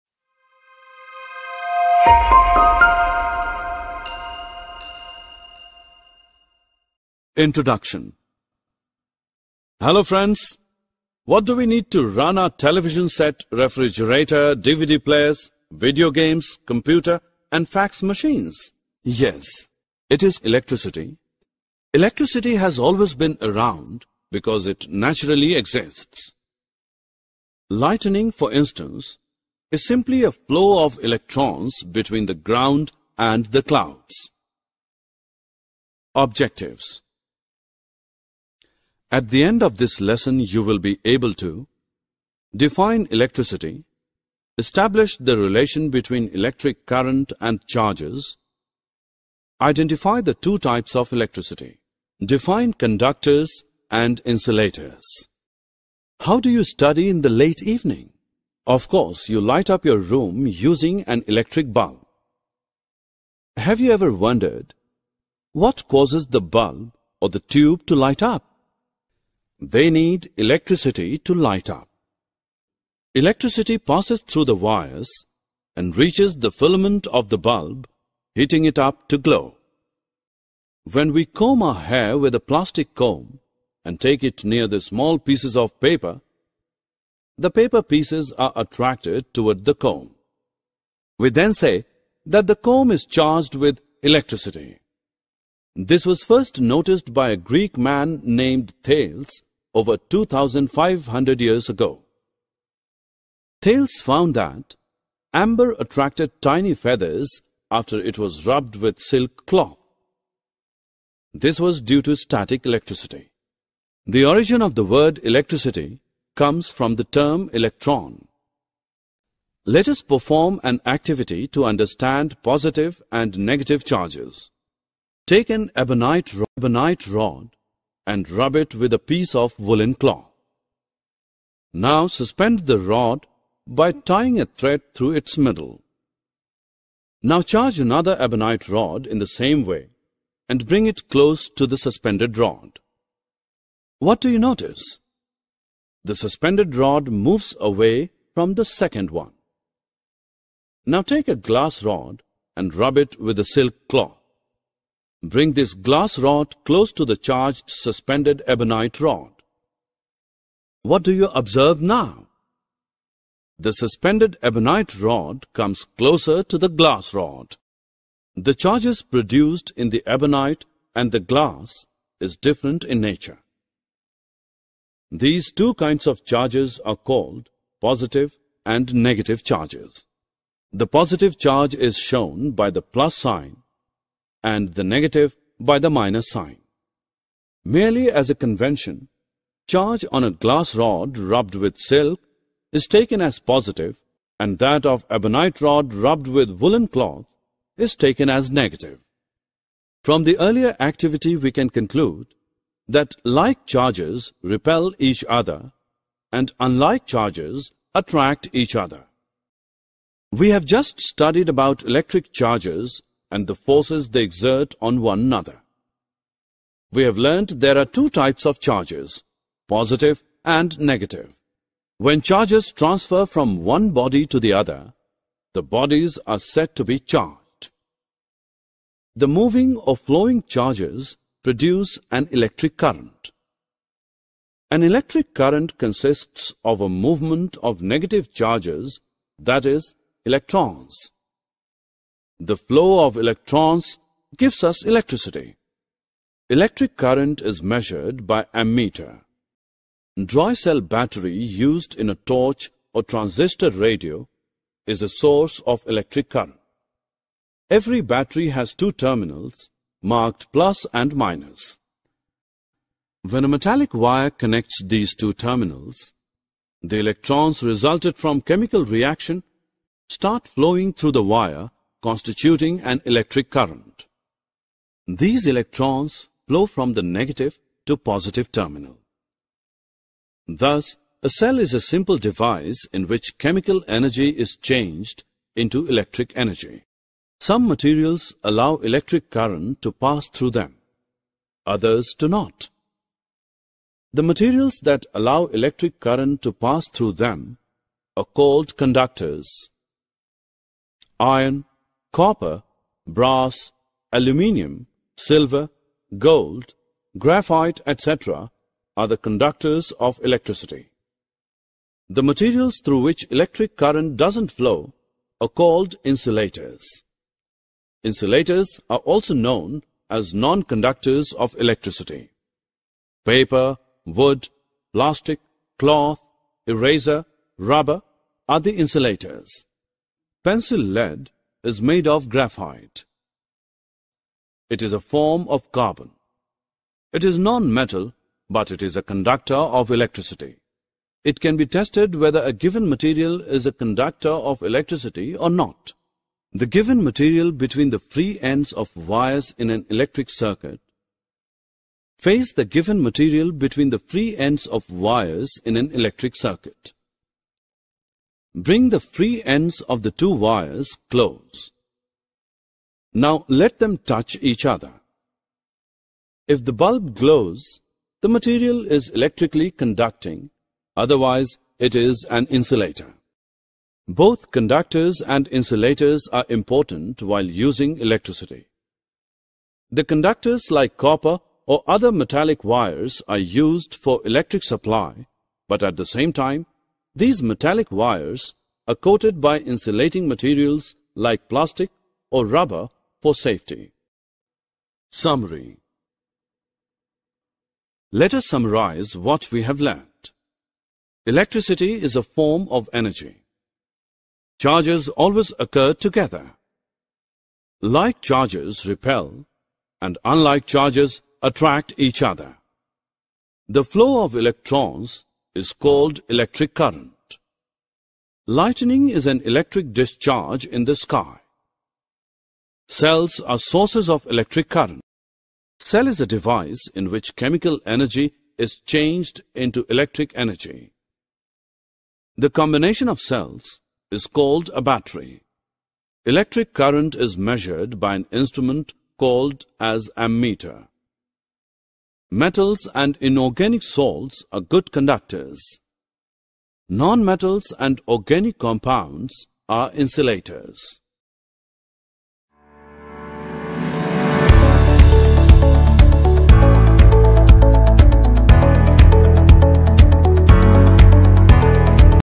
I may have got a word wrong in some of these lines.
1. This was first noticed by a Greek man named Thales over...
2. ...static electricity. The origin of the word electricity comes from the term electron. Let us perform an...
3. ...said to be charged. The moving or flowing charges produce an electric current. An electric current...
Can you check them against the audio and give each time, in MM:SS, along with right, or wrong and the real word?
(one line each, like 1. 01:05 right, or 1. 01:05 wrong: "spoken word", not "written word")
1. 01:35 right
2. 01:52 right
3. 03:46 right.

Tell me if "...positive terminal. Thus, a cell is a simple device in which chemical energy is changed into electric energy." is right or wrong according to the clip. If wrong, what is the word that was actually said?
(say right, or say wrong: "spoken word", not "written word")
right.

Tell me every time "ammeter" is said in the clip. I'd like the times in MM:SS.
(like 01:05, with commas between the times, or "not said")
04:08, 07:20.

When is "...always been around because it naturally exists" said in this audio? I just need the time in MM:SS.
00:22.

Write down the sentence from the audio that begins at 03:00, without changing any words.
The positive charge is shown by the plus sign and the negative by the minus sign.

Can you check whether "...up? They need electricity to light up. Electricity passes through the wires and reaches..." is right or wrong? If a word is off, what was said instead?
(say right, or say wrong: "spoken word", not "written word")
right.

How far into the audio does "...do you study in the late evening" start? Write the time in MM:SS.
00:56.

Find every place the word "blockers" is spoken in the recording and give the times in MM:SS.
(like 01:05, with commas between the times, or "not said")
not said.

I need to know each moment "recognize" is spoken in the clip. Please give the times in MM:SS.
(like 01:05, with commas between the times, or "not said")
not said.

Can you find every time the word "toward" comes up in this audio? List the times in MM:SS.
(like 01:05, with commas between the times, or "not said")
01:29.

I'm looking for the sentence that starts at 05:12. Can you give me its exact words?
The materials through which electric current doesn't flow are called insulators.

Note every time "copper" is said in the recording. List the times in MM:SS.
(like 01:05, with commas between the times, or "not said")
05:02, 06:20.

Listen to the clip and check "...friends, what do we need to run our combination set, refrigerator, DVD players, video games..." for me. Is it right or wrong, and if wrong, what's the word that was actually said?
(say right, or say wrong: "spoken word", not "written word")
wrong: "television", not "combination".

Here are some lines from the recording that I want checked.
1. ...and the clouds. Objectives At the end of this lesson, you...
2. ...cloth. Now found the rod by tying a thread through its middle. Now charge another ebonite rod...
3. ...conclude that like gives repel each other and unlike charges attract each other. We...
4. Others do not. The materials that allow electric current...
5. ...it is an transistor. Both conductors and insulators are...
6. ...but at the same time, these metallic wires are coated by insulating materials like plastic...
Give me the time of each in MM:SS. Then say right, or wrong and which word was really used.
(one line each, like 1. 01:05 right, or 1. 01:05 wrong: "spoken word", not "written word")
1. 00:33 right
2. 02:09 wrong: "suspend", not "found"
3. 03:21 wrong: "charges", not "gives"
4. 04:51 right
5. 06:11 wrong: "insulator", not "transistor"
6. 06:25 right.